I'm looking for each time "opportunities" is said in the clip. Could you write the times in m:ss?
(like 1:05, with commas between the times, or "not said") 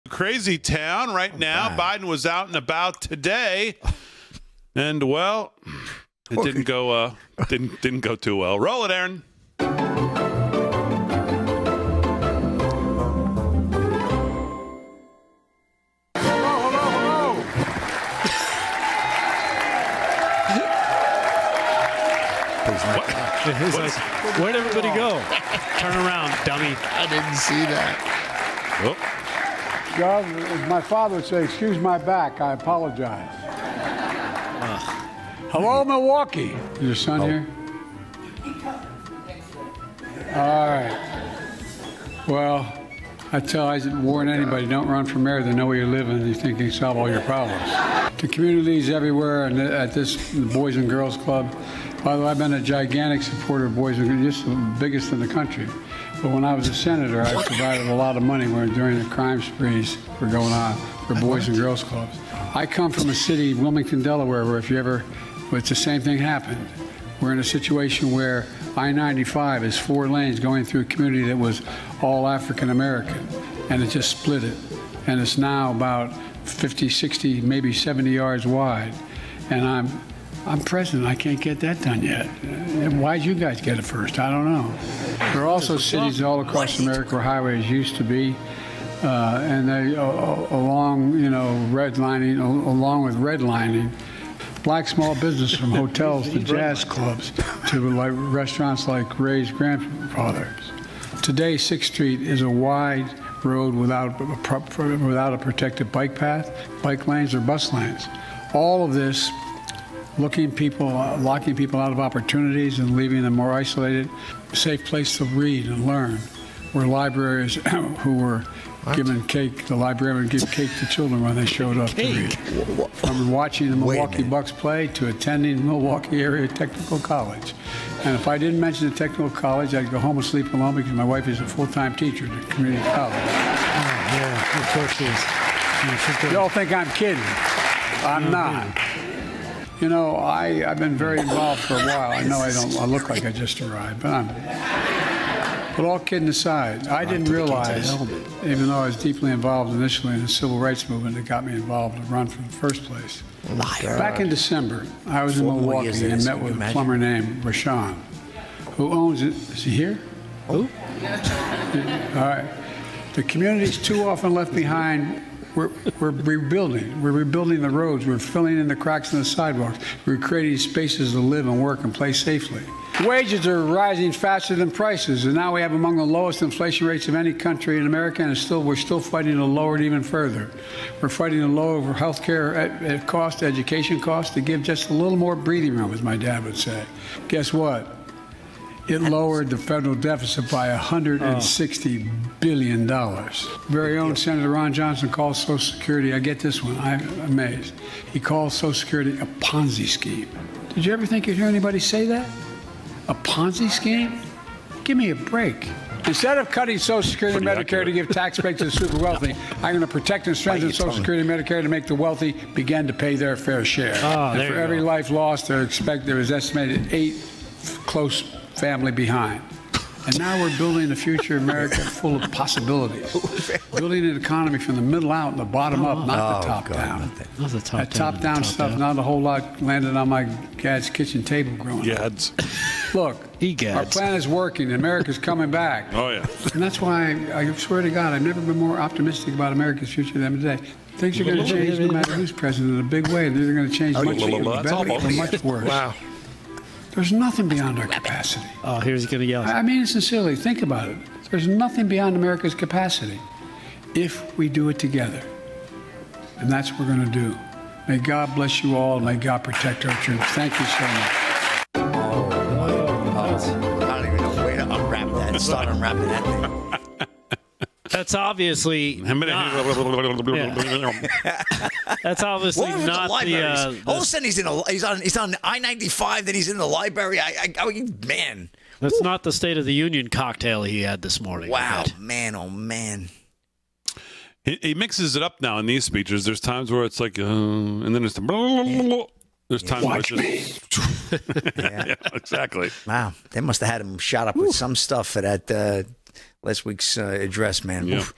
1:51.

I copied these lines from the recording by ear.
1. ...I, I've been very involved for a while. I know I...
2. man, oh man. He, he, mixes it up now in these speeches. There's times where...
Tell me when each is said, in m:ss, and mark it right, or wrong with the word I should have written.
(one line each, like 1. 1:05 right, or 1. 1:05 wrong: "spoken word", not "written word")
1. 2:20 right
2. 4:41 right.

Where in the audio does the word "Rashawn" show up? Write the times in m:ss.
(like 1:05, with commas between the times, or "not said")
2:37.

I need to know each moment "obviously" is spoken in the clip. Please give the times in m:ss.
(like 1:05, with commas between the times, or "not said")
4:28, 4:32.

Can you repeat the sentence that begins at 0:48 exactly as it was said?
the communities everywhere and at this Boys and Girls Club.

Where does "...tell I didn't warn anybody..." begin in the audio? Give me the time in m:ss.
0:43.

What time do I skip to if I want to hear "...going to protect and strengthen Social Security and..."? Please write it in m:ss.
3:29.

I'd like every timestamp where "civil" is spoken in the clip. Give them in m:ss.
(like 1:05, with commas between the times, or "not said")
2:30.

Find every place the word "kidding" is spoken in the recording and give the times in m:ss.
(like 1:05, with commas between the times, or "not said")
2:16, 2:25.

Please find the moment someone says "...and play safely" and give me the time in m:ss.
2:51.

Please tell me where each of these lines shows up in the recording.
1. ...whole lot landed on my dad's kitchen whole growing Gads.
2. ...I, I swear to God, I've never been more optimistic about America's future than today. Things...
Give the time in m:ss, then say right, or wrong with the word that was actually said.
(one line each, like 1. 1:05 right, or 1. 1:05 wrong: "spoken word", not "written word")
1. 3:49 wrong: "table", not "whole"
2. 3:57 right.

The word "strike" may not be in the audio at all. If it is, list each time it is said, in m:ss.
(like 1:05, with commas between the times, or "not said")
not said.